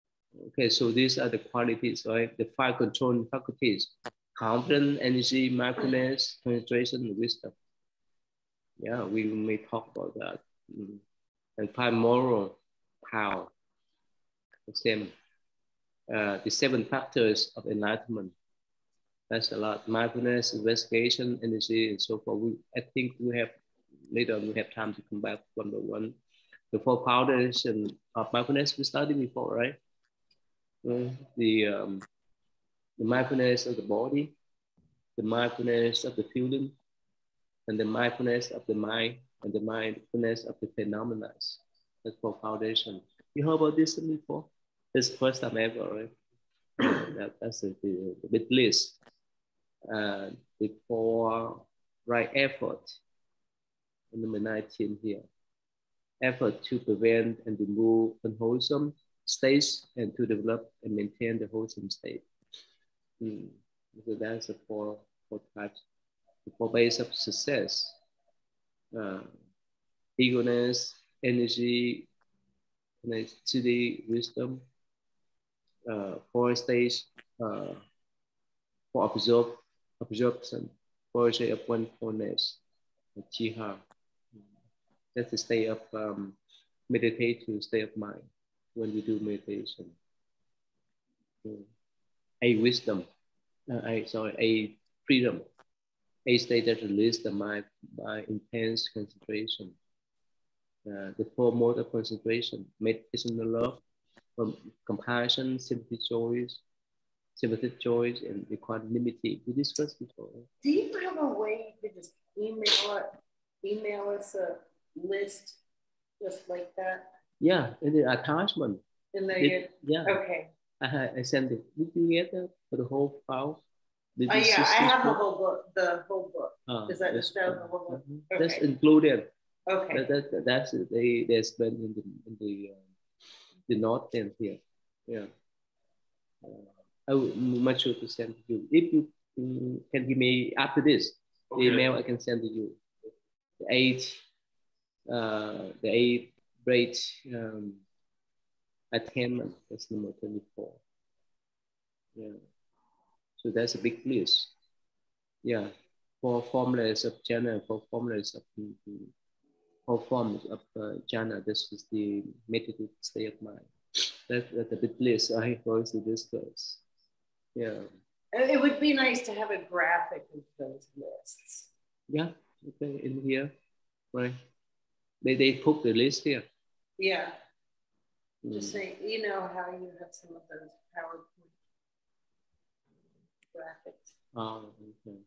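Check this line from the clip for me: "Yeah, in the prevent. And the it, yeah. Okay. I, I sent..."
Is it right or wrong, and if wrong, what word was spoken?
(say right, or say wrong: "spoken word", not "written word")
wrong: "attachment", not "prevent".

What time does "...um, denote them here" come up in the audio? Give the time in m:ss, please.
2:12.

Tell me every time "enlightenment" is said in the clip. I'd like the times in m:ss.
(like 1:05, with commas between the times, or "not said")
0:17.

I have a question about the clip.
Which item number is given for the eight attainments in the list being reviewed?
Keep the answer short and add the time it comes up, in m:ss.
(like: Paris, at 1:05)
24, at 2:29.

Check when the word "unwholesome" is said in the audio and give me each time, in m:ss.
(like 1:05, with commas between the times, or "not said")
0:58.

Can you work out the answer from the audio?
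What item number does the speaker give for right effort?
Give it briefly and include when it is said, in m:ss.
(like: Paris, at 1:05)
19, at 0:54.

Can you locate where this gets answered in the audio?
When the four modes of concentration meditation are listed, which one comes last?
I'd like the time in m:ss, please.
1:48.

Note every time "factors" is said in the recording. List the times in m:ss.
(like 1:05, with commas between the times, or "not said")
0:16.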